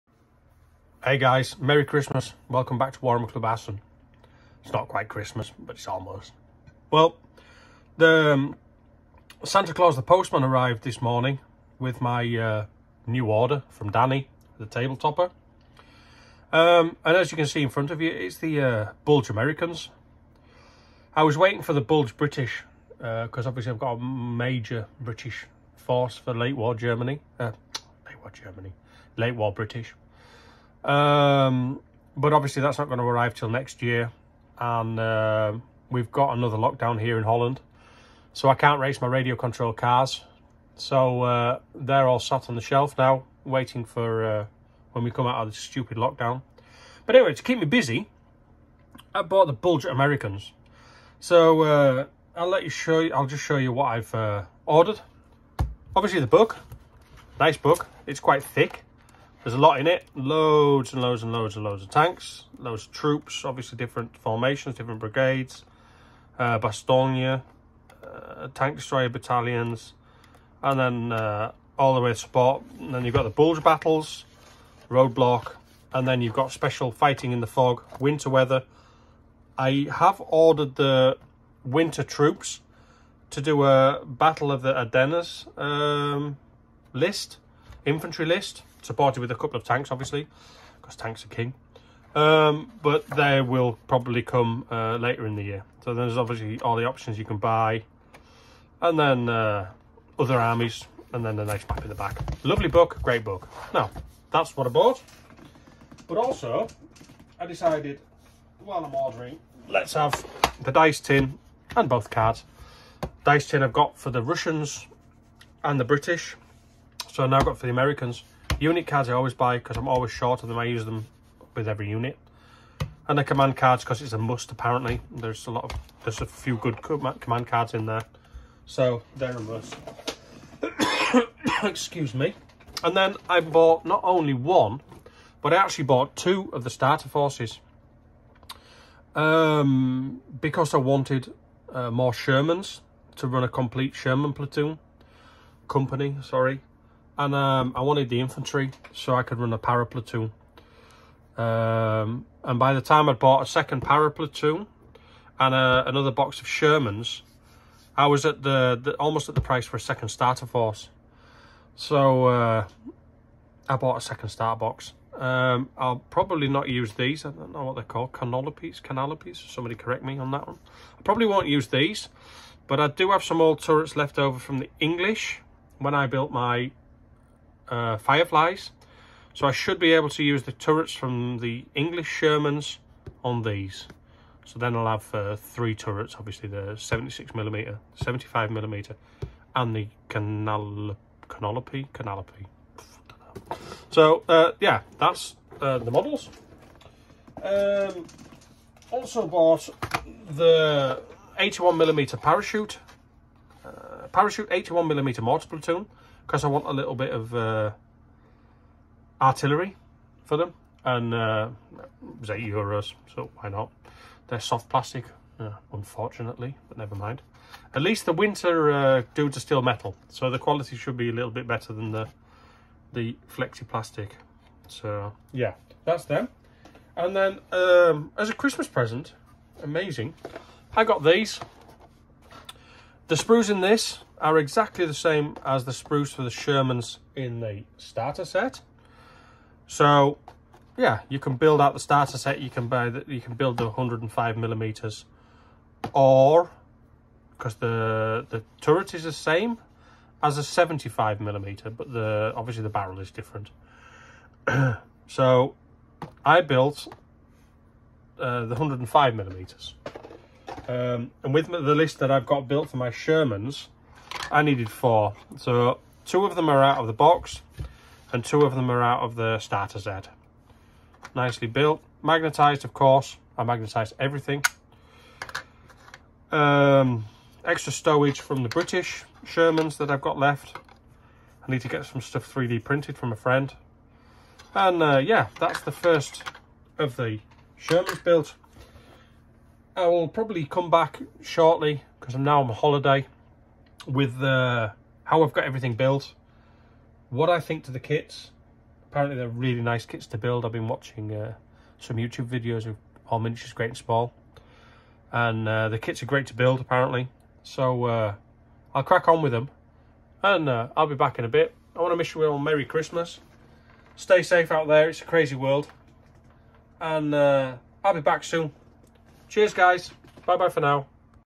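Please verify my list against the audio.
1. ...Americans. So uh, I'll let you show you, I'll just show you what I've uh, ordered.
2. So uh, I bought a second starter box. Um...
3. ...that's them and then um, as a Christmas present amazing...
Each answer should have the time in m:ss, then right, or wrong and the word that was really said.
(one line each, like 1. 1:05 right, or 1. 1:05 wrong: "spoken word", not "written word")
1. 0:49 right
2. 2:41 right
3. 3:45 right.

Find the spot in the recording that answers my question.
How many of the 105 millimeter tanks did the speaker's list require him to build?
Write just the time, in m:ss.
4:24.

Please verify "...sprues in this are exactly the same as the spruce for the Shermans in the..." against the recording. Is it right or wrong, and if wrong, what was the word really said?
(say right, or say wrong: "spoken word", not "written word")
right.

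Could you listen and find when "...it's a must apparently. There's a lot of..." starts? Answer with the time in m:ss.
2:04.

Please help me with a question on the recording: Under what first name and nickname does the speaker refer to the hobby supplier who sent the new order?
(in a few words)
Danny, the table topper.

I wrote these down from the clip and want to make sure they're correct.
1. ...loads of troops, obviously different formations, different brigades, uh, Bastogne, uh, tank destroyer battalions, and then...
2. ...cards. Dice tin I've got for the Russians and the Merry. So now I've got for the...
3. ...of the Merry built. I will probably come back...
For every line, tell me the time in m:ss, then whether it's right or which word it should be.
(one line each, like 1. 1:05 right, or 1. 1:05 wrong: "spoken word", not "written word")
1. 1:02 right
2. 1:52 wrong: "British", not "Merry"
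3. 4:46 wrong: "Shermans", not "Merry".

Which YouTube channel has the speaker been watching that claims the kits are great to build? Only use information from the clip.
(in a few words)
All Miniatures Great and Small.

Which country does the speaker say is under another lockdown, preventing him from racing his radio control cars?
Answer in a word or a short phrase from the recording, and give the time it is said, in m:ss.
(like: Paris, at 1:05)
Holland, at 0:37.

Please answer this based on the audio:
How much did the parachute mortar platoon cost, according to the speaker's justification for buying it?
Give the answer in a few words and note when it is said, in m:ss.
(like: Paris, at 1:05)
8 euros, at 3:32.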